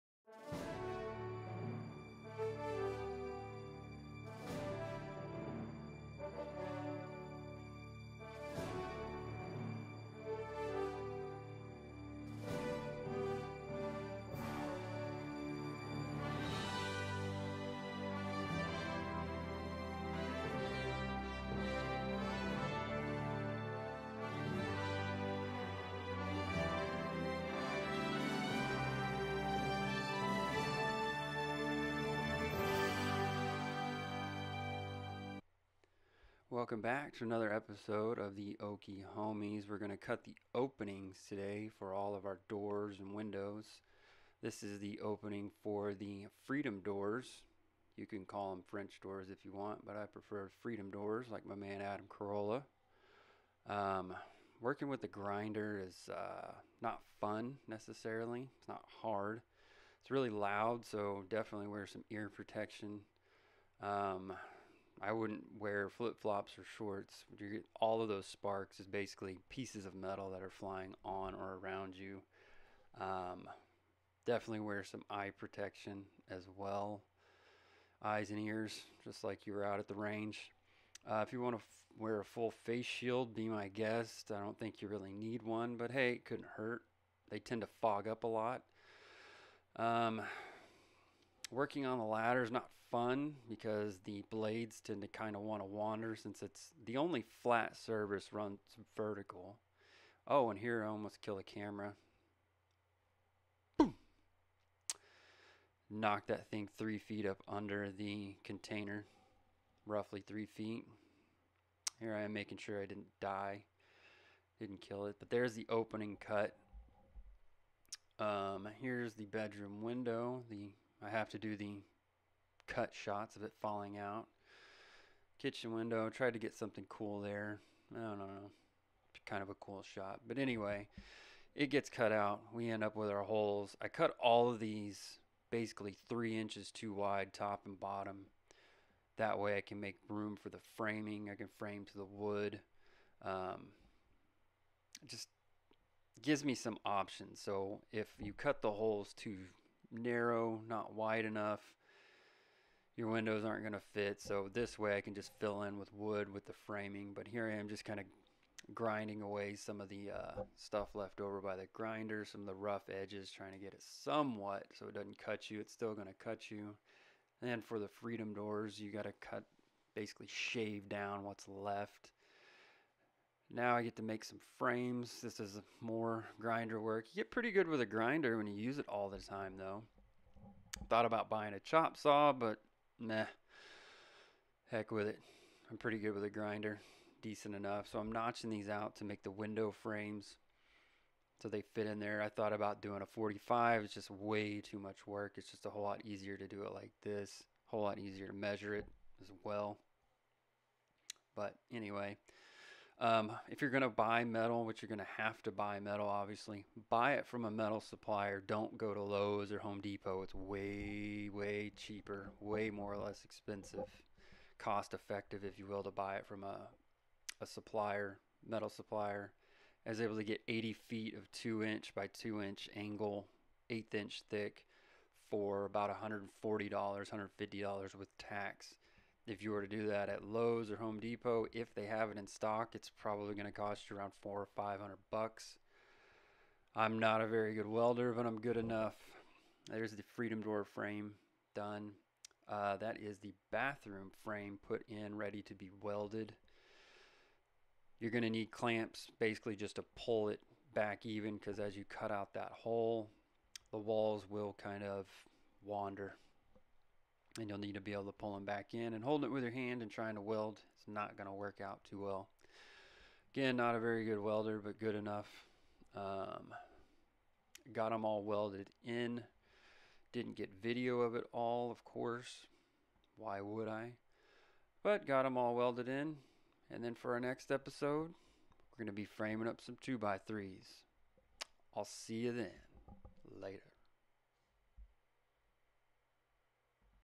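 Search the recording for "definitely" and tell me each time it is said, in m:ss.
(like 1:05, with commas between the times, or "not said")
1:01, 1:14.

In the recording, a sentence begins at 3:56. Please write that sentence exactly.
I'm not a very good welder, but I'm good enough.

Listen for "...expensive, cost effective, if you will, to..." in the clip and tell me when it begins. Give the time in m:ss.
3:33.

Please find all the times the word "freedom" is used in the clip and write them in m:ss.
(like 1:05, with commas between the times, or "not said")
0:46, 0:50, 2:47, 4:00.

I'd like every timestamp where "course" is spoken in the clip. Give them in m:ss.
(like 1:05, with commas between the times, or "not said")
4:31.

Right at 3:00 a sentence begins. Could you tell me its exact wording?
Thought about buying a chop saw, but nah.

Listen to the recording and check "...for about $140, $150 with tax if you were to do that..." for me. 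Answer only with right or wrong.
right.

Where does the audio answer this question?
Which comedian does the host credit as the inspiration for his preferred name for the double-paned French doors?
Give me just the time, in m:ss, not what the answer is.
0:51.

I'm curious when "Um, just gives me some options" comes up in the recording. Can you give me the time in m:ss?
2:23.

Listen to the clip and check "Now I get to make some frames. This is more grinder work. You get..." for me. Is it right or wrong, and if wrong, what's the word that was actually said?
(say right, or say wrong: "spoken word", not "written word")
right.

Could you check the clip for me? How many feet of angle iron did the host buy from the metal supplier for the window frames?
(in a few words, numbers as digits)
80 feet.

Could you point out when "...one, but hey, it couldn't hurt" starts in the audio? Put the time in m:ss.
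1:25.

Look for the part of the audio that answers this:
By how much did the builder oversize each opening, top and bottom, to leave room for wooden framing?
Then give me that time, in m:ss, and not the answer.
2:16.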